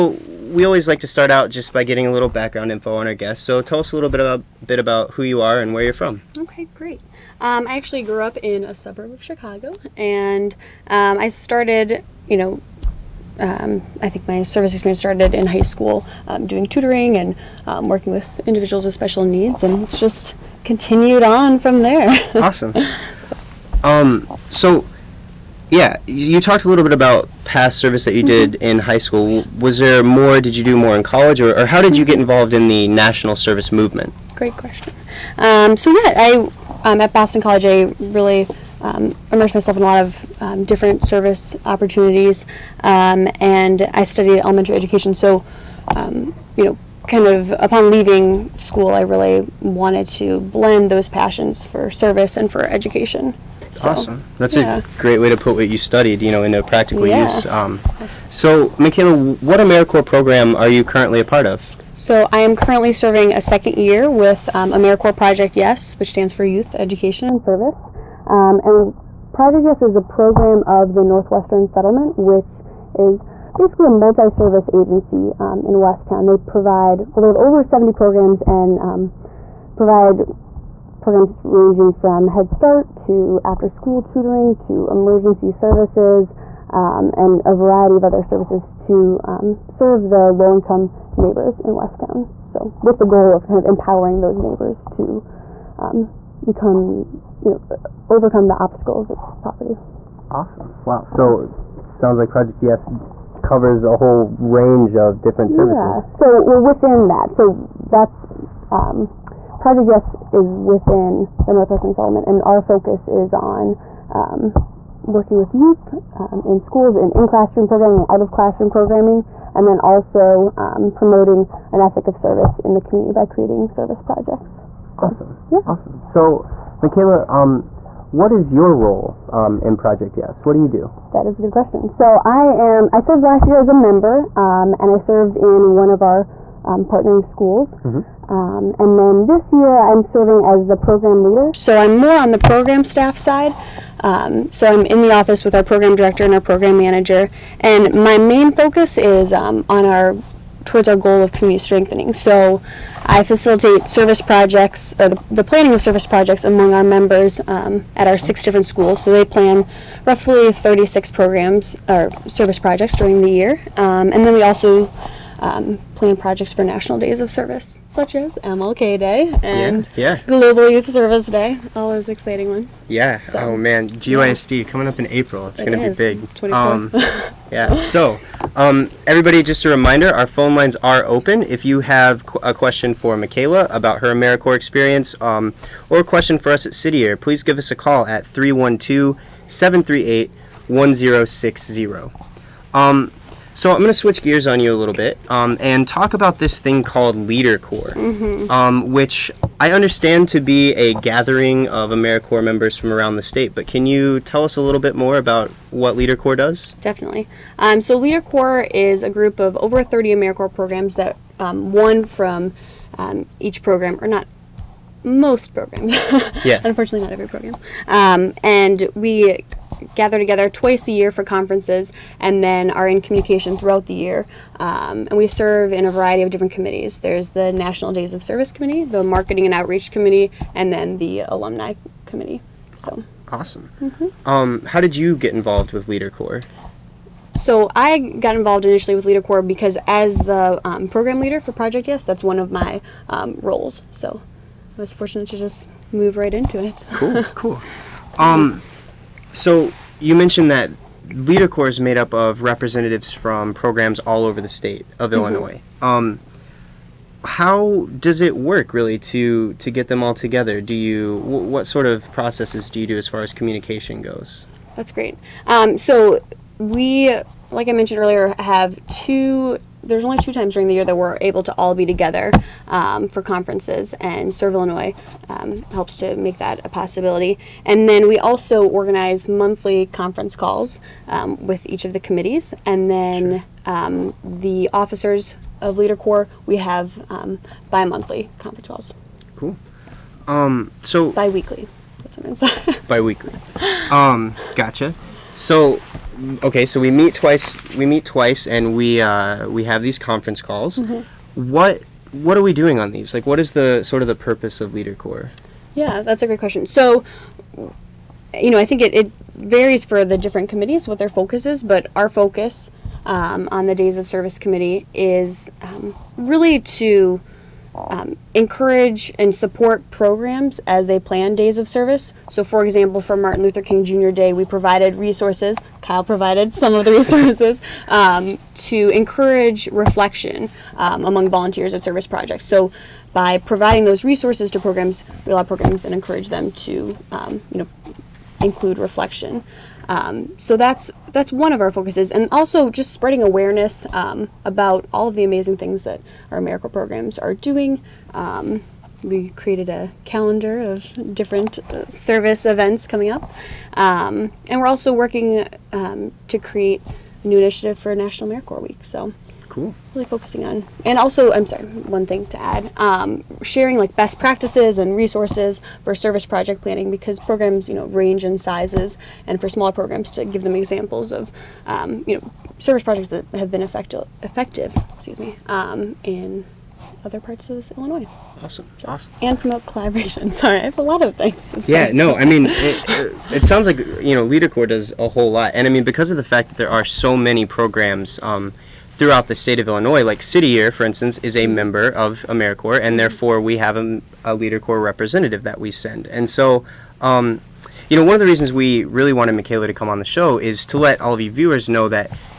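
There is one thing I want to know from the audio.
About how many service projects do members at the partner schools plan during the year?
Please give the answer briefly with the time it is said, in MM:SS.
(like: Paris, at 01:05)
36, at 02:40.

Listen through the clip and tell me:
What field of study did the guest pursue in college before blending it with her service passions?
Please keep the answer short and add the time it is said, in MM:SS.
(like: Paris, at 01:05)
elementary education, at 00:44.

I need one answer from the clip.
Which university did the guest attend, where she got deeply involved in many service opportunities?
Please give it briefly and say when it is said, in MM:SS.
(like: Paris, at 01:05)
Boston College, at 00:37.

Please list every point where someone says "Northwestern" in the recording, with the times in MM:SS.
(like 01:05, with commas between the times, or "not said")
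01:11, 01:51.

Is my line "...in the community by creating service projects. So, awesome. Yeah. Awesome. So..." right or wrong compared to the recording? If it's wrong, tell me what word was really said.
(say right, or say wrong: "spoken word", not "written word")
right.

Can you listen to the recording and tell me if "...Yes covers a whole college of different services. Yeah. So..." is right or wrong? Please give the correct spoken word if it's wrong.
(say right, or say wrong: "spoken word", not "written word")
wrong: "range", not "college".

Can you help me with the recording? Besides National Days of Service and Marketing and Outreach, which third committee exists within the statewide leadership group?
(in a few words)
Alumni Committee.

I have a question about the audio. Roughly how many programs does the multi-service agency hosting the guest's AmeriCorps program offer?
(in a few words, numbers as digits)
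over 70.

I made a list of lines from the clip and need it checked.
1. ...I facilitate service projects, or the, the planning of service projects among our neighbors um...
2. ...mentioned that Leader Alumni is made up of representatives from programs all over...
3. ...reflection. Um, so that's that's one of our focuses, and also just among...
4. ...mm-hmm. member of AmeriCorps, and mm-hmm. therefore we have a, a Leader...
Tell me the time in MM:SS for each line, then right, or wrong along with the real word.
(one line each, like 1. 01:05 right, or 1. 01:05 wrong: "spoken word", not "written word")
1. 02:33 wrong: "members", not "neighbors"
2. 04:10 wrong: "Corps", not "Alumni"
3. 05:38 wrong: "spreading", not "among"
4. 06:31 right.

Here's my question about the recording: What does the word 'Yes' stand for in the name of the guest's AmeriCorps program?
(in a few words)
Youth Education and Service.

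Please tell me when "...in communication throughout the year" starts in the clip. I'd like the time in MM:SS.
03:42.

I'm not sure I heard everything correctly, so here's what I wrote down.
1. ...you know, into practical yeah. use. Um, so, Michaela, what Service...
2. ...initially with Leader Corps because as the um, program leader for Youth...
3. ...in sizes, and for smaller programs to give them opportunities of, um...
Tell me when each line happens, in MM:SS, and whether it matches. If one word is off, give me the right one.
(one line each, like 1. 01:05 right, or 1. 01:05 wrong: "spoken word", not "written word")
1. 00:56 wrong: "AmeriCorps", not "Service"
2. 03:58 wrong: "Project", not "Youth"
3. 06:08 wrong: "examples", not "opportunities".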